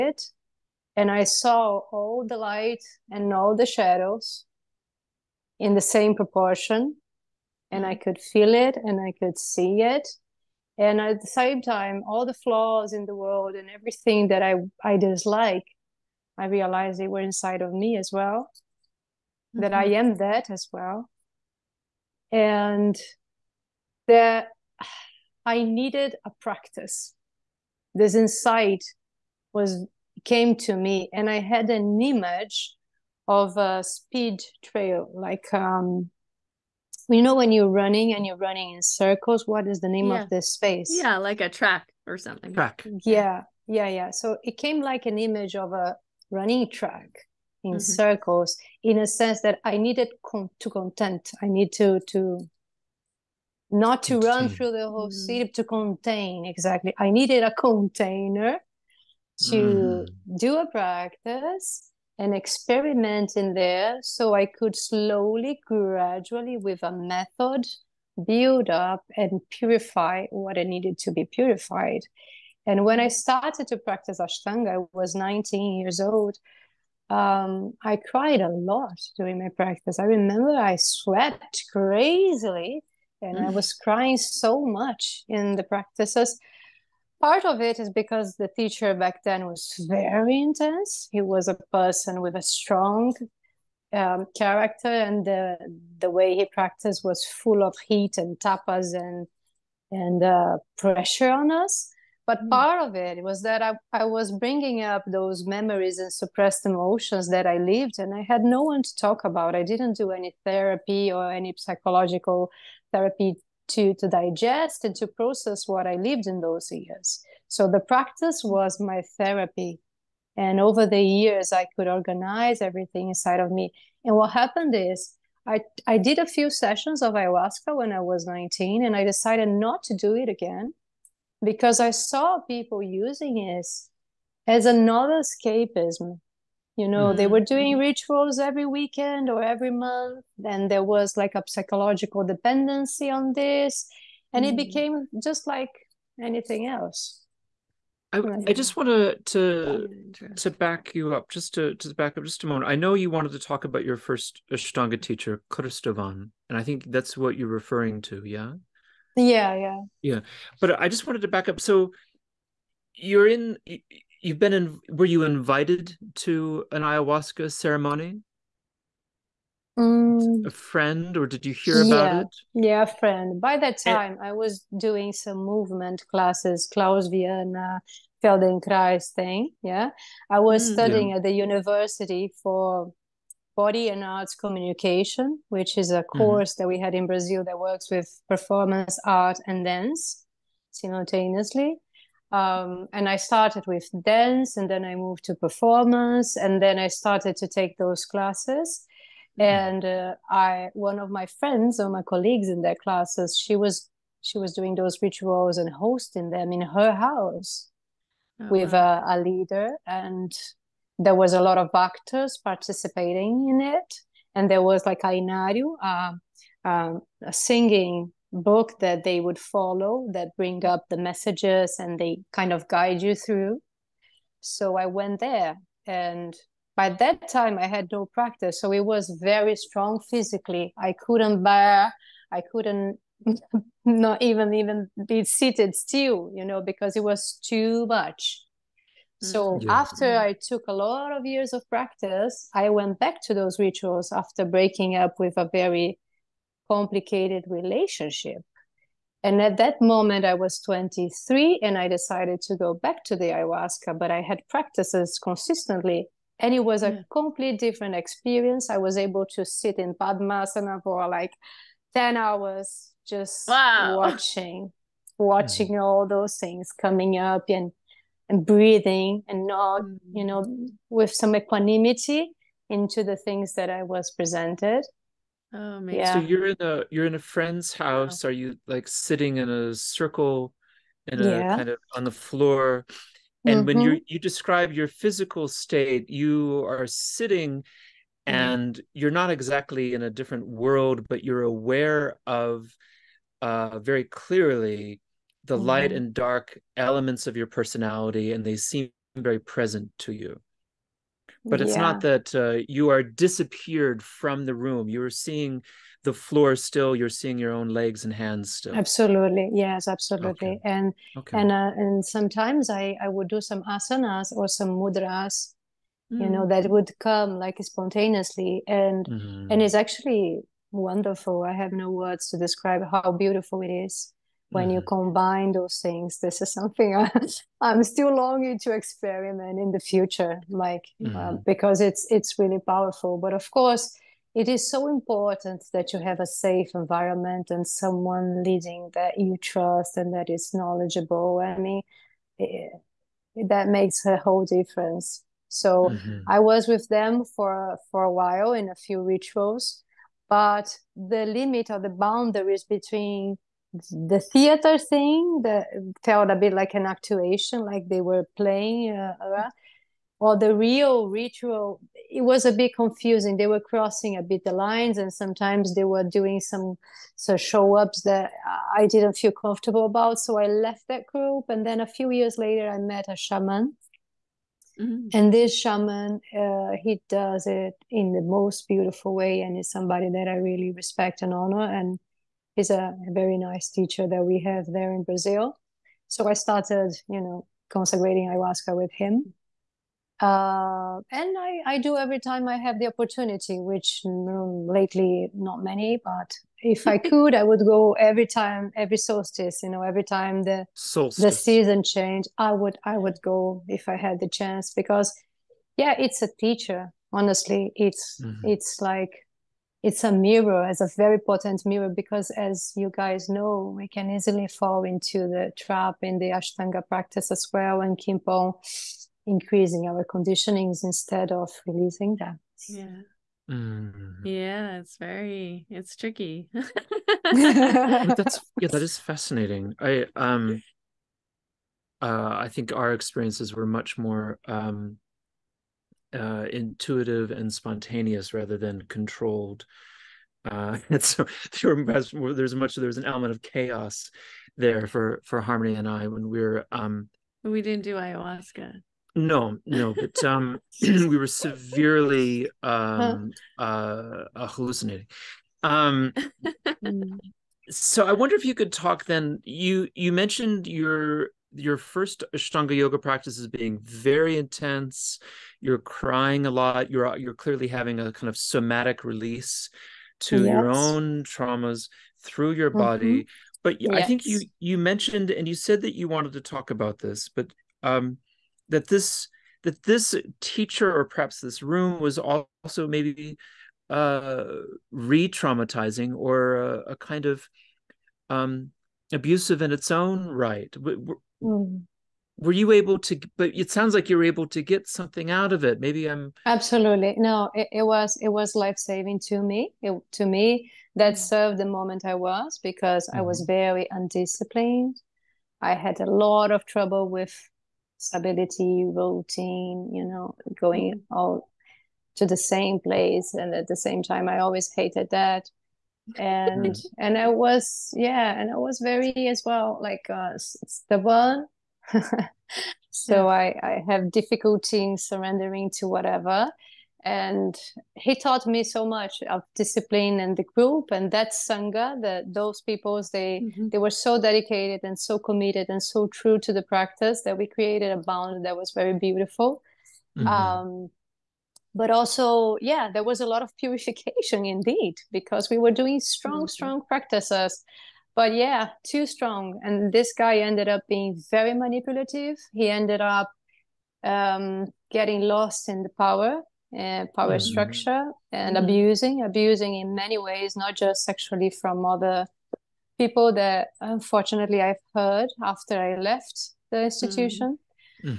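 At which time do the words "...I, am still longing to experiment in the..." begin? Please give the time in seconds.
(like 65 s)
327 s.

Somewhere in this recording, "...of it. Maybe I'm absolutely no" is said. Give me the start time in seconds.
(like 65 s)
495 s.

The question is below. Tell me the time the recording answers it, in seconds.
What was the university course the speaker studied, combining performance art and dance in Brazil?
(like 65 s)
183 s.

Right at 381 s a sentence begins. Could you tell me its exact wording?
And he's a very nice teacher that we have there in Brazil.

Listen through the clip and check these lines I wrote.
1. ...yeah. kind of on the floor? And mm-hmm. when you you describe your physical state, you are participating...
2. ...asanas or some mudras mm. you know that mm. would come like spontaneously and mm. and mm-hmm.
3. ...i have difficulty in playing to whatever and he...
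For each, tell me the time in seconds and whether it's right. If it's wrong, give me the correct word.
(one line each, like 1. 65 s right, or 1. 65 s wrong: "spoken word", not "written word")
1. 281 s wrong: "sitting", not "participating"
2. 313 s right
3. 523 s wrong: "surrendering", not "playing".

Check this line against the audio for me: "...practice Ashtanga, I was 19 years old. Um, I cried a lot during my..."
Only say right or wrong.
right.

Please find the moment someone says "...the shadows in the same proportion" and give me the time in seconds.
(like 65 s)
3 s.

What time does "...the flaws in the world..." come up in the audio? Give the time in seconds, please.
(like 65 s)
12 s.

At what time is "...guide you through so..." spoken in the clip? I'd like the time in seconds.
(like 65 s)
222 s.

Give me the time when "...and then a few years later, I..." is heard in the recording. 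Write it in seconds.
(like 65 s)
371 s.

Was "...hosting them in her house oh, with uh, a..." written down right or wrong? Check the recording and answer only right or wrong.
right.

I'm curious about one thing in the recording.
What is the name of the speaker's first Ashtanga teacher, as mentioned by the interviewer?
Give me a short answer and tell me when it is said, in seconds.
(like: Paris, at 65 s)
Kristovan, at 155 s.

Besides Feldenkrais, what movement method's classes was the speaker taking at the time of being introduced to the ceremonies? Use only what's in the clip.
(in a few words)
Klauss Vianna.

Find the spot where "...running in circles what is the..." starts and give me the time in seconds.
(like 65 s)
38 s.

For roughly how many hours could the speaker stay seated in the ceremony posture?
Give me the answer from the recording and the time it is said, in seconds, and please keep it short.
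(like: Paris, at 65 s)
10, at 261 s.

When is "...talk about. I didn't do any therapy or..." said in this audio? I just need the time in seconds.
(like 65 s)
108 s.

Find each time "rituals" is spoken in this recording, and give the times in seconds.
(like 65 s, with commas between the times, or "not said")
137 s, 205 s, 243 s, 349 s, 361 s.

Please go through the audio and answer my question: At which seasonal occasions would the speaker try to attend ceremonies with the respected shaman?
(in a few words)
every solstice.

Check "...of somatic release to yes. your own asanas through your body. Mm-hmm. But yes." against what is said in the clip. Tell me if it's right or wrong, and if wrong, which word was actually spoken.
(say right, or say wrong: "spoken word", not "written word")
wrong: "traumas", not "asanas".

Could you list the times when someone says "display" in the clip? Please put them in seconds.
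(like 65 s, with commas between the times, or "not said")
not said.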